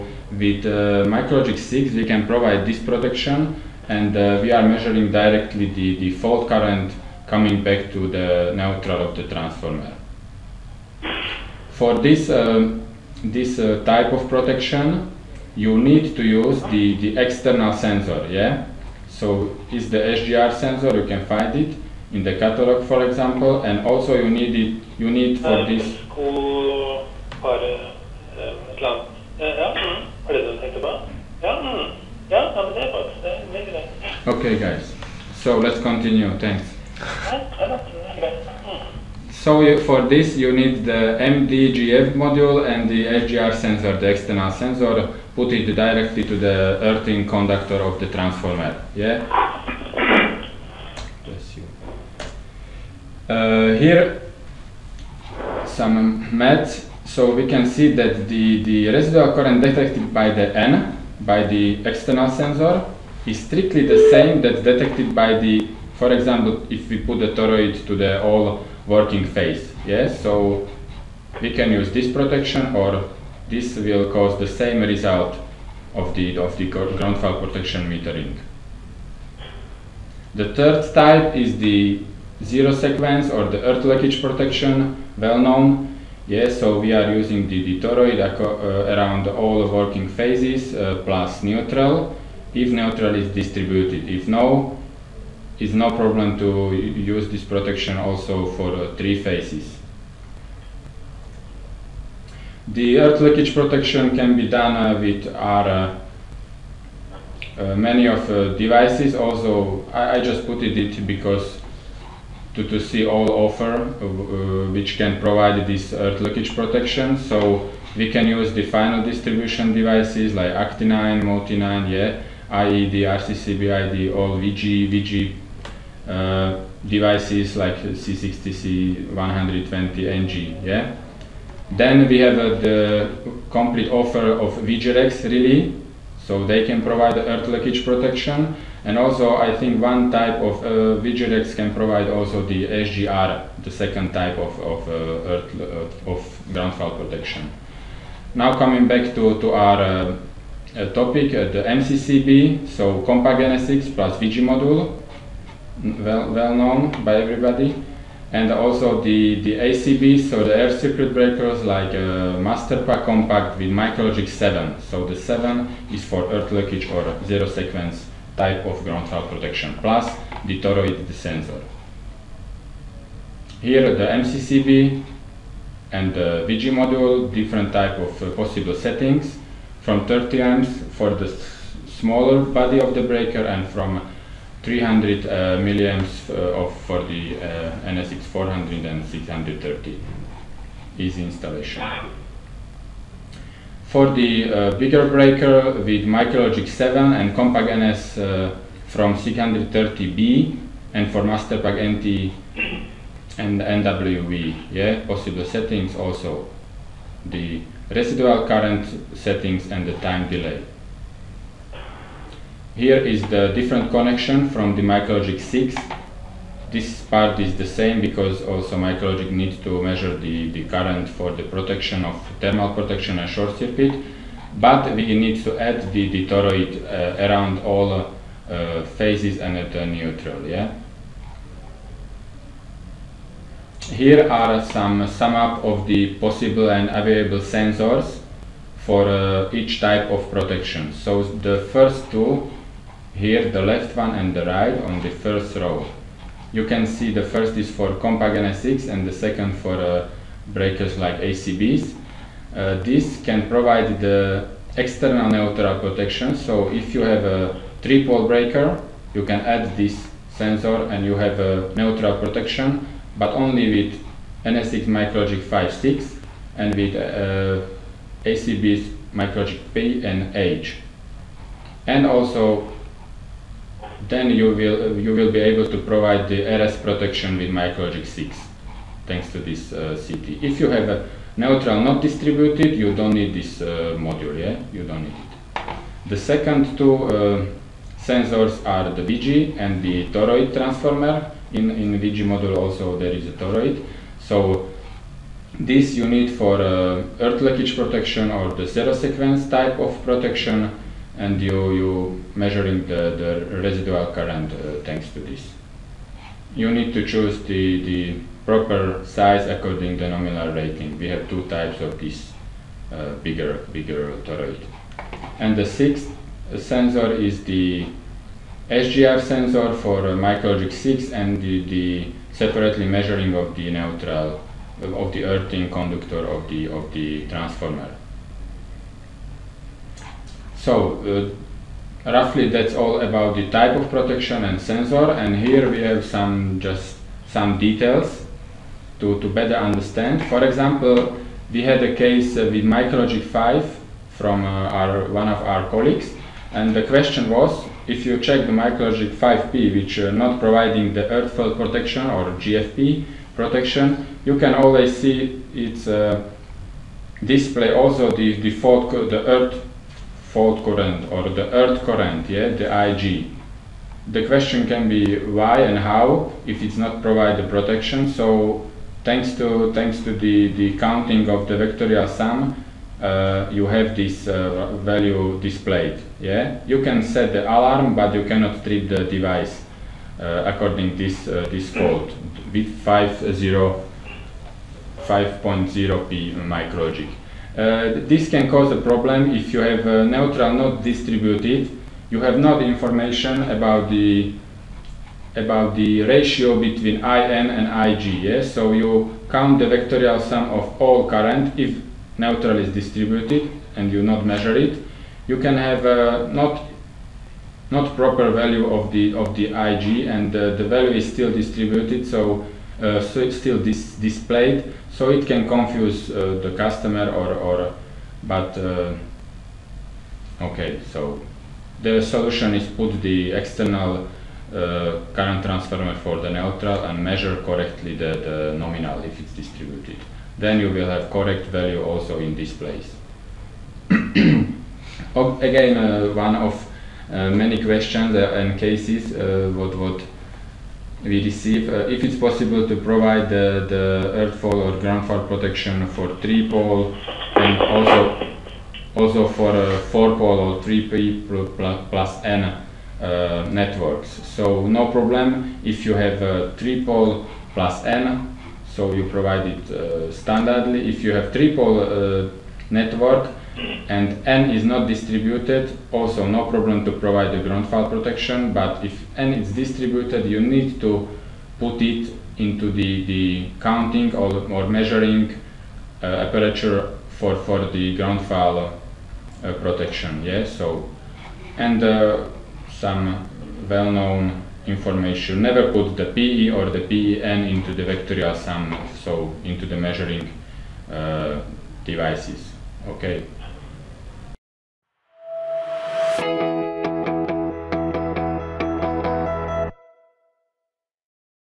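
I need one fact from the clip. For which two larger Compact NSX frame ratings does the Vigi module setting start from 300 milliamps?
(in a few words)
400 and 630.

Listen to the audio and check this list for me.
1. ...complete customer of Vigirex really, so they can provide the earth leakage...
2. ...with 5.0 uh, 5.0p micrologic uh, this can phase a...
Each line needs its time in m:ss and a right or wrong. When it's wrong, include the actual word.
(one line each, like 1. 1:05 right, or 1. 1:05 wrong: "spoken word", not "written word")
1. 2:13 wrong: "offer", not "customer"
2. 6:22 wrong: "cause", not "phase".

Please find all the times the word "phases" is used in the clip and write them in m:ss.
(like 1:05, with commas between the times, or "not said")
1:09, 1:30, 1:39, 3:48.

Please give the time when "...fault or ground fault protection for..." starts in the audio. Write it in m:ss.
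7:24.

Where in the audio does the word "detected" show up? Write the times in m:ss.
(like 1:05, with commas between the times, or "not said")
0:59, 1:04.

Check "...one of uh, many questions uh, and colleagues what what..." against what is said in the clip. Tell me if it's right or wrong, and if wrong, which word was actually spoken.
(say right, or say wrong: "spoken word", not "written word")
wrong: "cases", not "colleagues".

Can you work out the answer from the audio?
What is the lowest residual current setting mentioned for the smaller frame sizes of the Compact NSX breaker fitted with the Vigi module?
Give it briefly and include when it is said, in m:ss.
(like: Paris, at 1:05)
30 amps, at 3:00.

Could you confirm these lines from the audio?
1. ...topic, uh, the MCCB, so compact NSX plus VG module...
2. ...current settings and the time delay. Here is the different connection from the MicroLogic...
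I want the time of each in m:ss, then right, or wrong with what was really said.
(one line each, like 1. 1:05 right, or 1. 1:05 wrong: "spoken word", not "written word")
1. 2:30 right
2. 3:28 right.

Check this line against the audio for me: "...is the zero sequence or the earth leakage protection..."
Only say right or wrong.
right.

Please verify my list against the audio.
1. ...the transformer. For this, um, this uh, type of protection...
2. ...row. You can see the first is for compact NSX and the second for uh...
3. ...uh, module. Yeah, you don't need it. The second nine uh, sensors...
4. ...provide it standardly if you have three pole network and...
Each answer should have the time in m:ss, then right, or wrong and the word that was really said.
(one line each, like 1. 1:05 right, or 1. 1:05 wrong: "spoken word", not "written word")
1. 0:09 right
2. 4:05 right
3. 4:43 wrong: "two", not "nine"
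4. 7:39 right.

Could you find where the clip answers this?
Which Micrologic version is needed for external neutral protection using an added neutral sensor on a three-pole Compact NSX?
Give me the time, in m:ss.
4:24.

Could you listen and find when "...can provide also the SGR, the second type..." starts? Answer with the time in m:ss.
2:21.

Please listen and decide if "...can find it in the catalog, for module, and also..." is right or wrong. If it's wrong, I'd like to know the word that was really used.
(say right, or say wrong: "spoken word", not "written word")
wrong: "example", not "module".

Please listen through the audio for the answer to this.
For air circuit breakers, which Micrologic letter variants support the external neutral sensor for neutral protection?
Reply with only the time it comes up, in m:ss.
4:29.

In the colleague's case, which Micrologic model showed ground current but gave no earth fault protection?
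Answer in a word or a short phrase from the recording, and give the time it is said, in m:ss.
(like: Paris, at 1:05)
Micrologic 5P, at 5:48.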